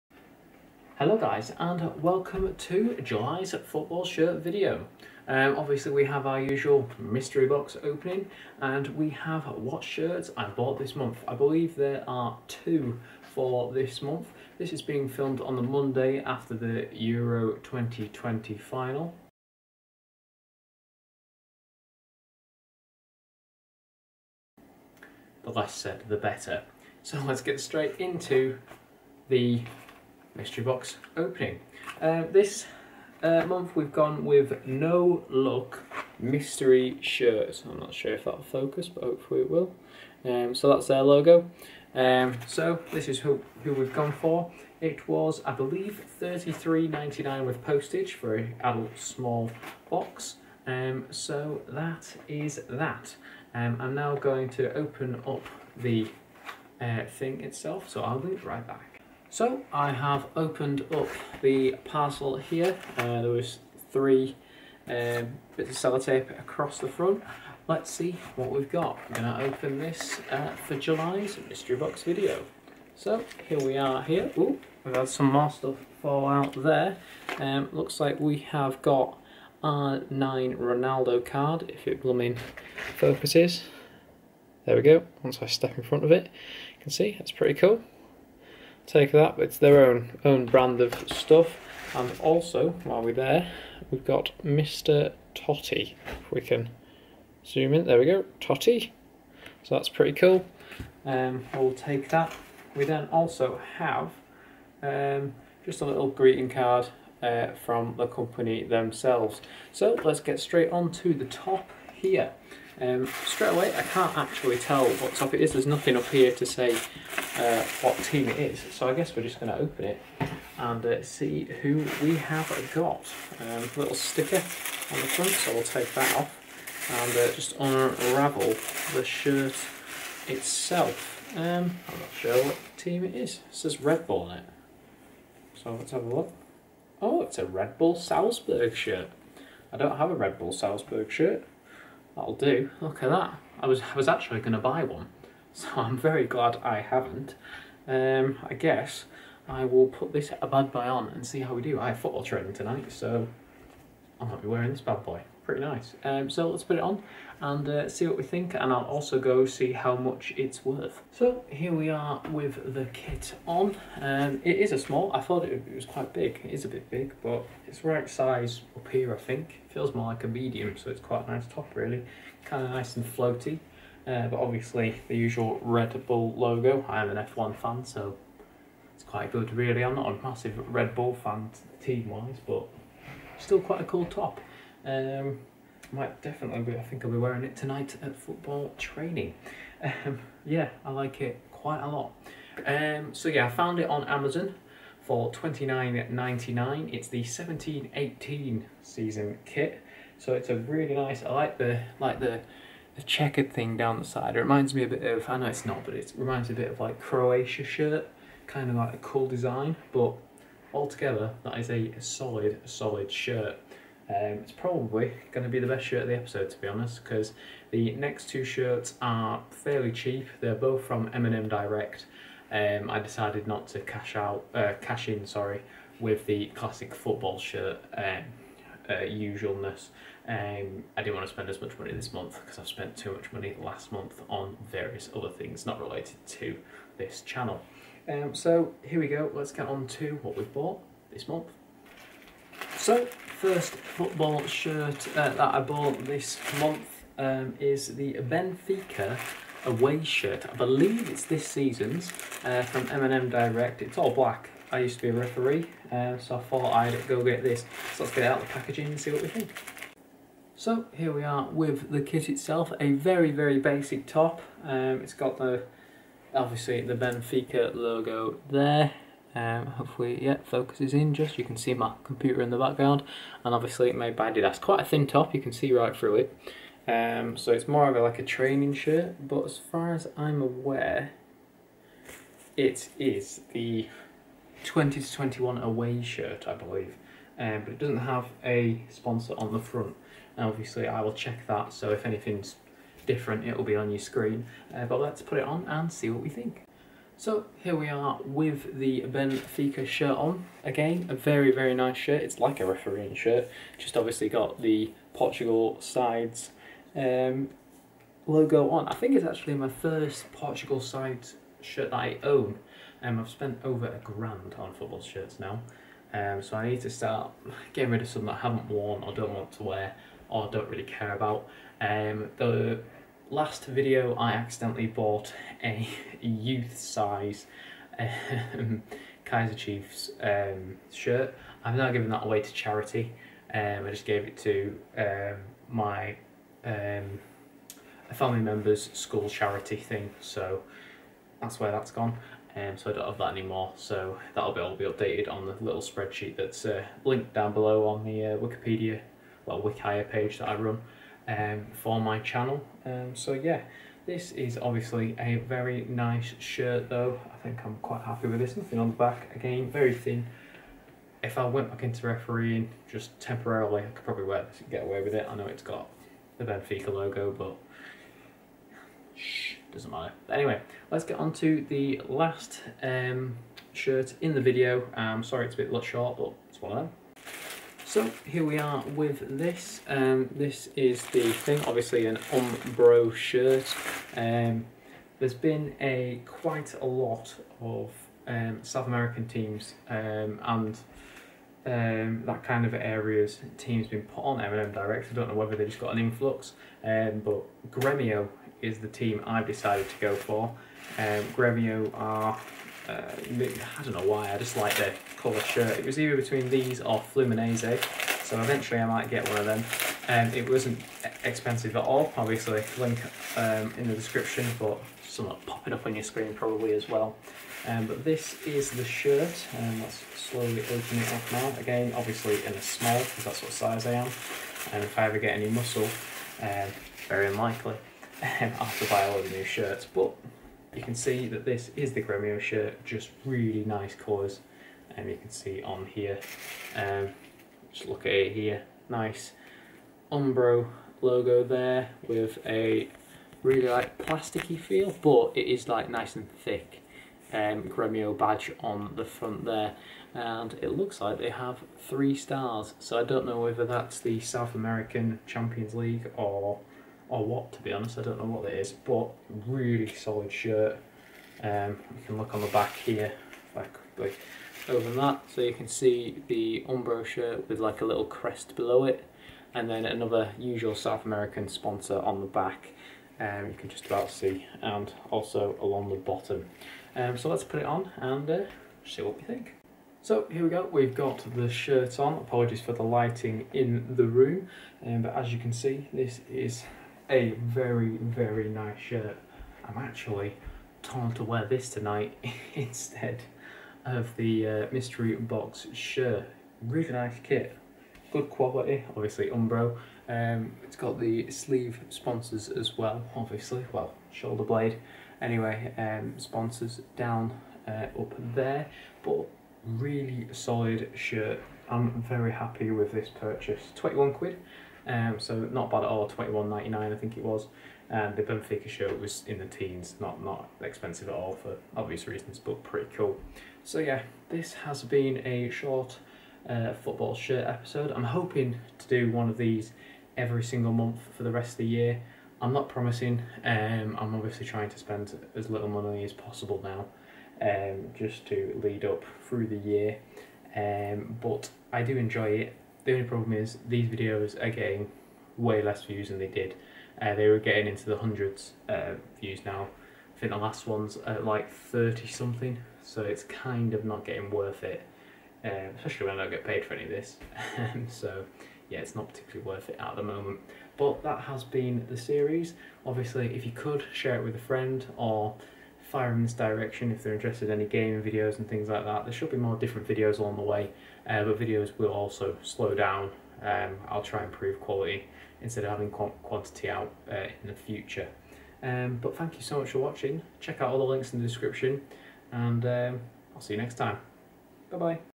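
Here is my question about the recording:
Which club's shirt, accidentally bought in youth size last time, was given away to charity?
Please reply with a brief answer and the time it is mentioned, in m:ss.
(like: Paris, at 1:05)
Kaizer Chiefs, at 5:29.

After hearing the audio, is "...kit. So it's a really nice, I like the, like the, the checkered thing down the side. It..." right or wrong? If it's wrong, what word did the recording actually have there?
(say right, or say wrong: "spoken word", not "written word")
right.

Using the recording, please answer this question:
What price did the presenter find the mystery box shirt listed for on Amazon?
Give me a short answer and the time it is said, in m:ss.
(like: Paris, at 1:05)
29.99, at 3:15.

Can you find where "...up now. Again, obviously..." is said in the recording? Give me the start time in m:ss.
7:01.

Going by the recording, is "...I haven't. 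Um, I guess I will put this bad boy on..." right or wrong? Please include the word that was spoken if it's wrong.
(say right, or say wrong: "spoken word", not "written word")
right.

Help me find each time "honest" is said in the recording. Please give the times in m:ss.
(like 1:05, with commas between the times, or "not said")
3:36, 7:37.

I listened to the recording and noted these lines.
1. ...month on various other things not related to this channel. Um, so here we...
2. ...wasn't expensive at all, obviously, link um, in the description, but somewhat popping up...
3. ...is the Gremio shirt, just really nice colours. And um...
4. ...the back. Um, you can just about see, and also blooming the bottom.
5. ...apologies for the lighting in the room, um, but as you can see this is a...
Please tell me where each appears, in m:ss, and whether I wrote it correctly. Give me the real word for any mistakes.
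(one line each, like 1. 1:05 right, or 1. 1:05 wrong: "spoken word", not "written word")
1. 3:53 right
2. 6:50 right
3. 7:11 right
4. 7:52 wrong: "along", not "blooming"
5. 8:02 right.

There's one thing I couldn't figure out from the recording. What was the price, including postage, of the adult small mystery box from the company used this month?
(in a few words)
$33.99.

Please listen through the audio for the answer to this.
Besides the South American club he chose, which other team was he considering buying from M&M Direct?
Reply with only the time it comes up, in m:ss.
6:47.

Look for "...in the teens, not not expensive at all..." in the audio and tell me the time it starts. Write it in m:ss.
8:39.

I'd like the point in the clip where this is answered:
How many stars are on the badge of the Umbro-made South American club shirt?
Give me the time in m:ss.
7:31.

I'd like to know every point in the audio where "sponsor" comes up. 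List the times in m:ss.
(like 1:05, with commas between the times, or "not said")
4:48, 7:51, 8:21, 8:26.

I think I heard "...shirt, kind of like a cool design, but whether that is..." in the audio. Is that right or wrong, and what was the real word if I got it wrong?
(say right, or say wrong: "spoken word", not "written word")
wrong: "altogether", not "whether".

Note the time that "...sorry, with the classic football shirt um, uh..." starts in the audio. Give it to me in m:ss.
3:45.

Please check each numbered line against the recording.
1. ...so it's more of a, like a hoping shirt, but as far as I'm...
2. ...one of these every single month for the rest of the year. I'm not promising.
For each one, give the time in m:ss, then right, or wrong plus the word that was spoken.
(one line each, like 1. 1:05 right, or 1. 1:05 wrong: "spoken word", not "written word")
1. 4:37 wrong: "training", not "hoping"
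2. 8:49 right.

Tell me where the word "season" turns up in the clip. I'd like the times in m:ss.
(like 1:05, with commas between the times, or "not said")
3:18, 4:11.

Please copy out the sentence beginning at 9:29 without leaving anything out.
There should be more different videos along the way, uh, but videos will also slow down.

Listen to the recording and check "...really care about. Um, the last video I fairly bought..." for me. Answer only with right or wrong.
wrong.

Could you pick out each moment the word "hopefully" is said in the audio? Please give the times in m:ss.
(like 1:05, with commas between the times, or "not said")
0:39, 4:29.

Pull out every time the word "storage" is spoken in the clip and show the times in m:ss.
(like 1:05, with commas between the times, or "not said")
not said.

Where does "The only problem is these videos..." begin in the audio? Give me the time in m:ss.
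9:02.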